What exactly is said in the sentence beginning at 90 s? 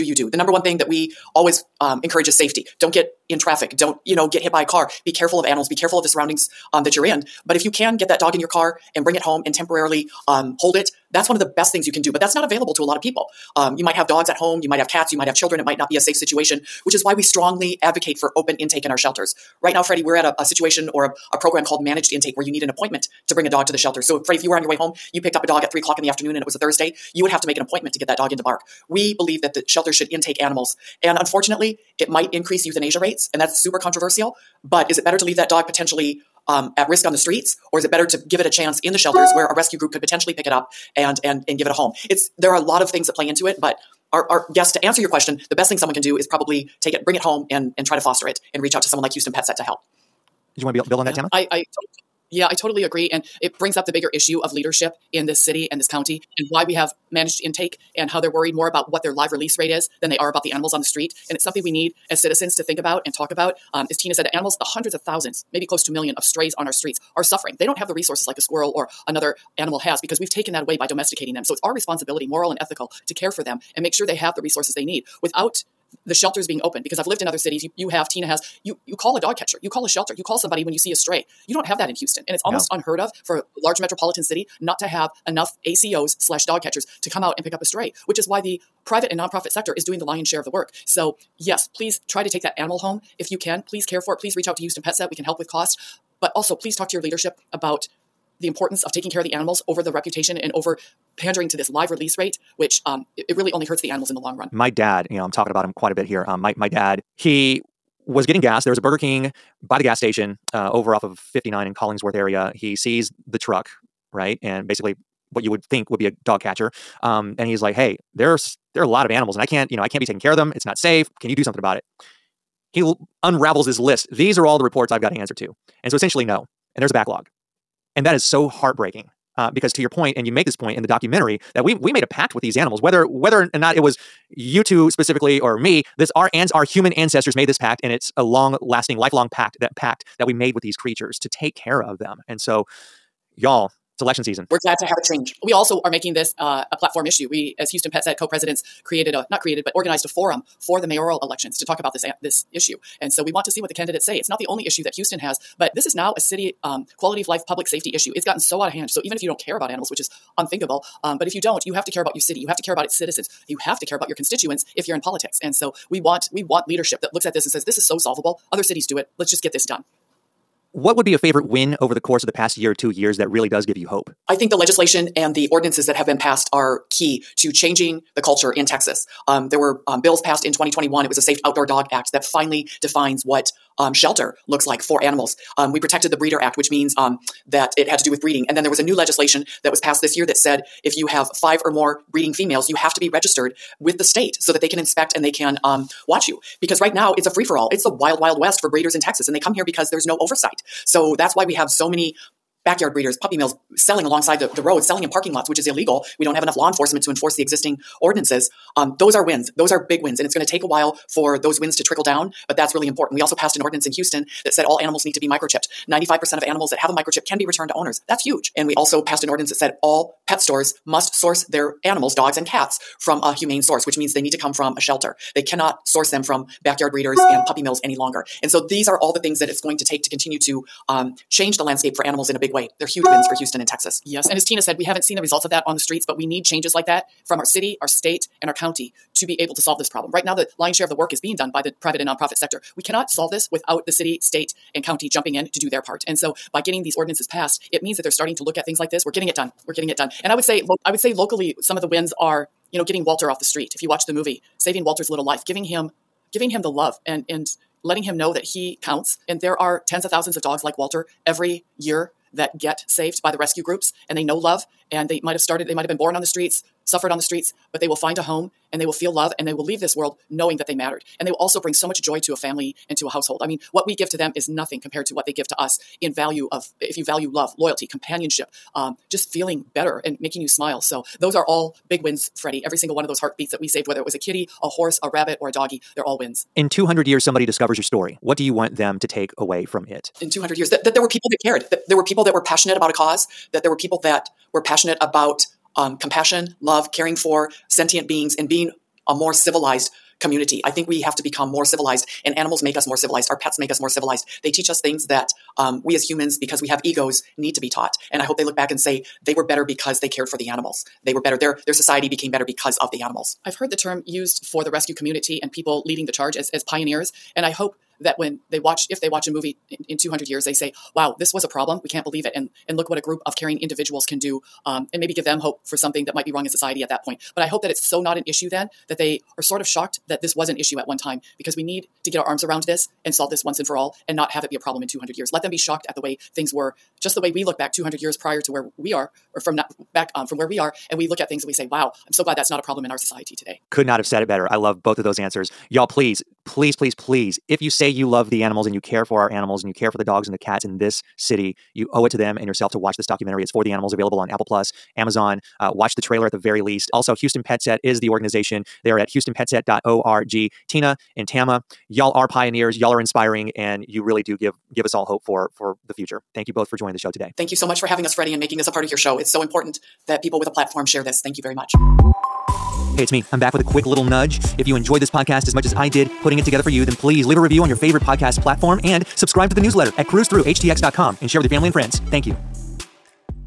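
So, yes, please try to take that animal home if you can.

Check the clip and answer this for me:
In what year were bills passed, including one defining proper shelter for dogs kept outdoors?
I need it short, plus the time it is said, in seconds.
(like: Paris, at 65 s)
2021, at 180 s.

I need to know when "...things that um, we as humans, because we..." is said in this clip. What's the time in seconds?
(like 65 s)
304 s.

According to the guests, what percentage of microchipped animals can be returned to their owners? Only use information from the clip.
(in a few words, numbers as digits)
95%.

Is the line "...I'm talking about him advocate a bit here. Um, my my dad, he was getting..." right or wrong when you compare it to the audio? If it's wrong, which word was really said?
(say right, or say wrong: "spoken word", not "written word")
wrong: "quite", not "advocate".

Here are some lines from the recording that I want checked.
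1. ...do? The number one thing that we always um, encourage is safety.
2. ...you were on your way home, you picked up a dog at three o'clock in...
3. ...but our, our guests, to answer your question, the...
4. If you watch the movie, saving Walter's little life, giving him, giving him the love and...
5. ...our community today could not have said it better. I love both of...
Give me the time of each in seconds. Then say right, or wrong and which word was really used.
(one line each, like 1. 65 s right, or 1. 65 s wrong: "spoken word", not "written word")
1. 0 s right
2. 24 s right
3. 43 s right
4. 253 s right
5. 342 s wrong: "society", not "community".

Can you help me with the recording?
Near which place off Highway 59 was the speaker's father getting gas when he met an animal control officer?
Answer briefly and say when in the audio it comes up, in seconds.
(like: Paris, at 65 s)
Collingsworth, at 111 s.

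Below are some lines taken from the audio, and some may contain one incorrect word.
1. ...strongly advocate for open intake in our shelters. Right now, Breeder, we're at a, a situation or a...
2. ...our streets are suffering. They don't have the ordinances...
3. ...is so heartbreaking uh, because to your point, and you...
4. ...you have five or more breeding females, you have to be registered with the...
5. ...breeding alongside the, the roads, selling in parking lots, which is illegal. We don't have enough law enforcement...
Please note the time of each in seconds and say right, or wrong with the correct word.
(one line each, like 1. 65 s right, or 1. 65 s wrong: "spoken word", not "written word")
1. 17 s wrong: "Freddy", not "Breeder"
2. 66 s wrong: "resources", not "ordinances"
3. 128 s right
4. 190 s right
5. 203 s wrong: "selling", not "breeding".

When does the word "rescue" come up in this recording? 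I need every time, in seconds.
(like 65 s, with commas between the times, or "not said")
39 s, 263 s, 314 s.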